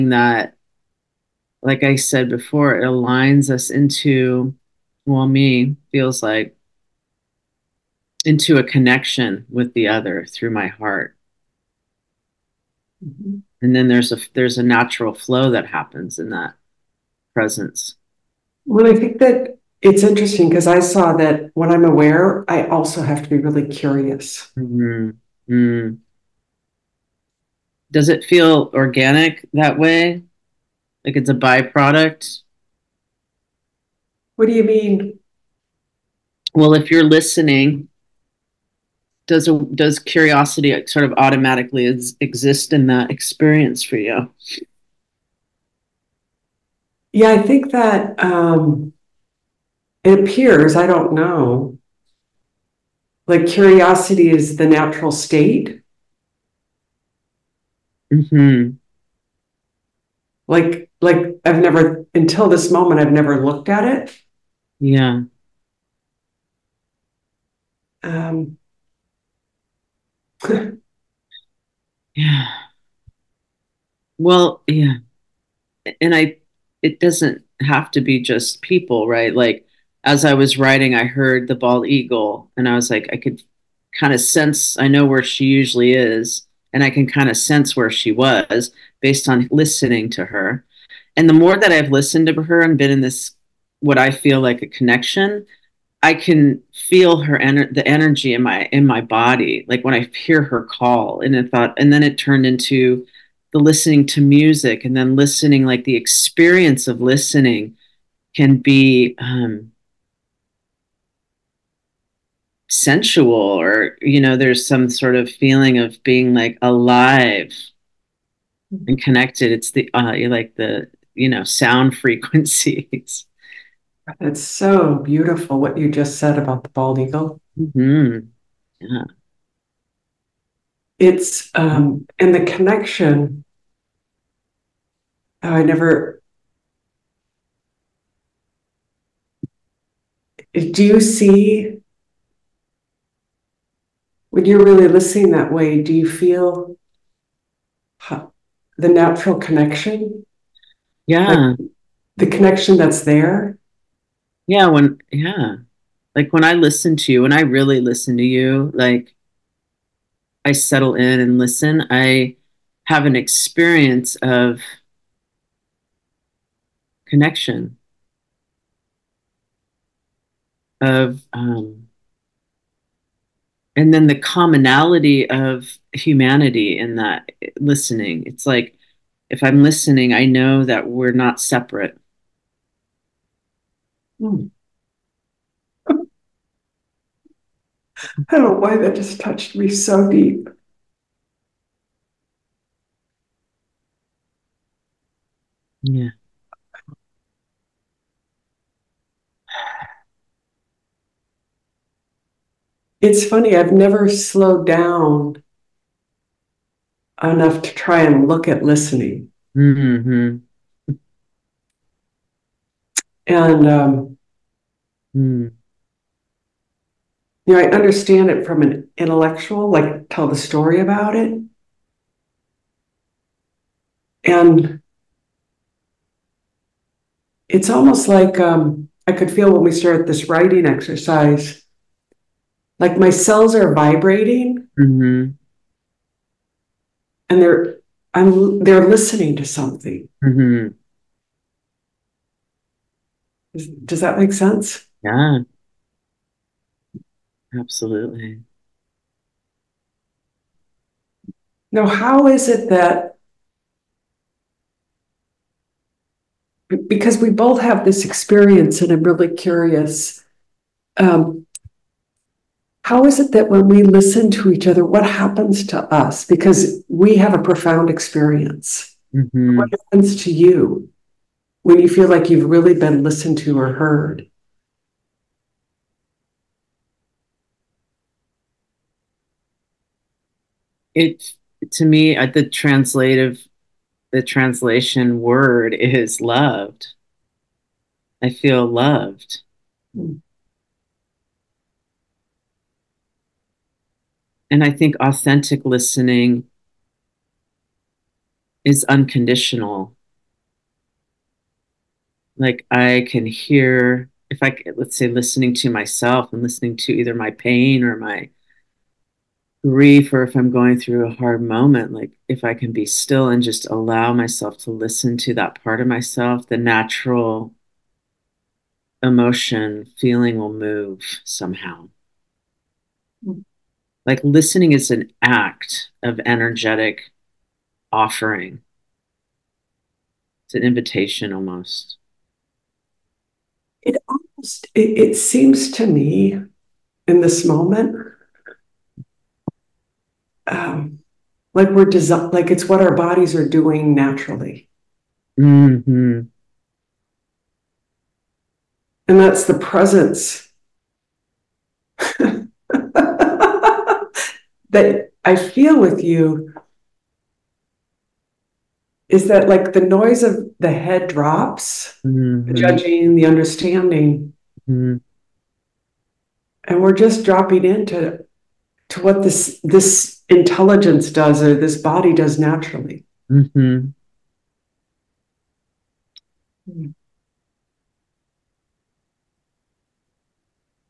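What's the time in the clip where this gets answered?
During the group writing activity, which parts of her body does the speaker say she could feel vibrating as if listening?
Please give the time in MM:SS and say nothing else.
03:53.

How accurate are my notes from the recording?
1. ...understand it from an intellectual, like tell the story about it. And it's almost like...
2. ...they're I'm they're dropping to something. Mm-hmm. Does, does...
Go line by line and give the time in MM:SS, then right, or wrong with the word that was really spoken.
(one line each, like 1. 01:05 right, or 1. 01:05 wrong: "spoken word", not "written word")
1. 03:37 right
2. 03:57 wrong: "listening", not "dropping".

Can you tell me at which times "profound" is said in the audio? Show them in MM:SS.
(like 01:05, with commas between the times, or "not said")
04:27.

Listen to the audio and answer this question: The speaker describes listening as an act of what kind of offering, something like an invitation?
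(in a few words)
energetic offering.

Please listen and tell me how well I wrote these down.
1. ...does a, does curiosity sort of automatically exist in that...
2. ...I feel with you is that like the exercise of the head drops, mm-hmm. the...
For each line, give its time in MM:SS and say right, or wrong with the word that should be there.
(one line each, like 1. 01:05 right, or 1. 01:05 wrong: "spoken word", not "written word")
1. 00:39 right
2. 05:55 wrong: "noise", not "exercise".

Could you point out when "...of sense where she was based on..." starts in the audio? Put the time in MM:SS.
01:27.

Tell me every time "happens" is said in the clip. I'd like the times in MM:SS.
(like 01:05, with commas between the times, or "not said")
00:15, 04:25, 04:29.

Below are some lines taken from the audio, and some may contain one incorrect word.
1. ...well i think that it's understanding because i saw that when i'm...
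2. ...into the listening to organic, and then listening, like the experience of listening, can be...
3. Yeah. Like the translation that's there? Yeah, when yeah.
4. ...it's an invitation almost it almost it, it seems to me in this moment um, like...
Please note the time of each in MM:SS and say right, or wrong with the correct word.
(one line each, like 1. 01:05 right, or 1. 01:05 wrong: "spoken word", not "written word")
1. 00:18 wrong: "interesting", not "understanding"
2. 01:42 wrong: "music", not "organic"
3. 02:31 wrong: "connection", not "translation"
4. 05:30 right.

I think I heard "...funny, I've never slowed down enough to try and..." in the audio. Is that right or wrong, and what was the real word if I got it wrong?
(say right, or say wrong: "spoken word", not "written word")
right.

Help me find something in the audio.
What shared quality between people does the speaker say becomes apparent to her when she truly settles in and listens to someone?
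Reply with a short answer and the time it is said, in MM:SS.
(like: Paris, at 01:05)
commonality of humanity, at 02:54.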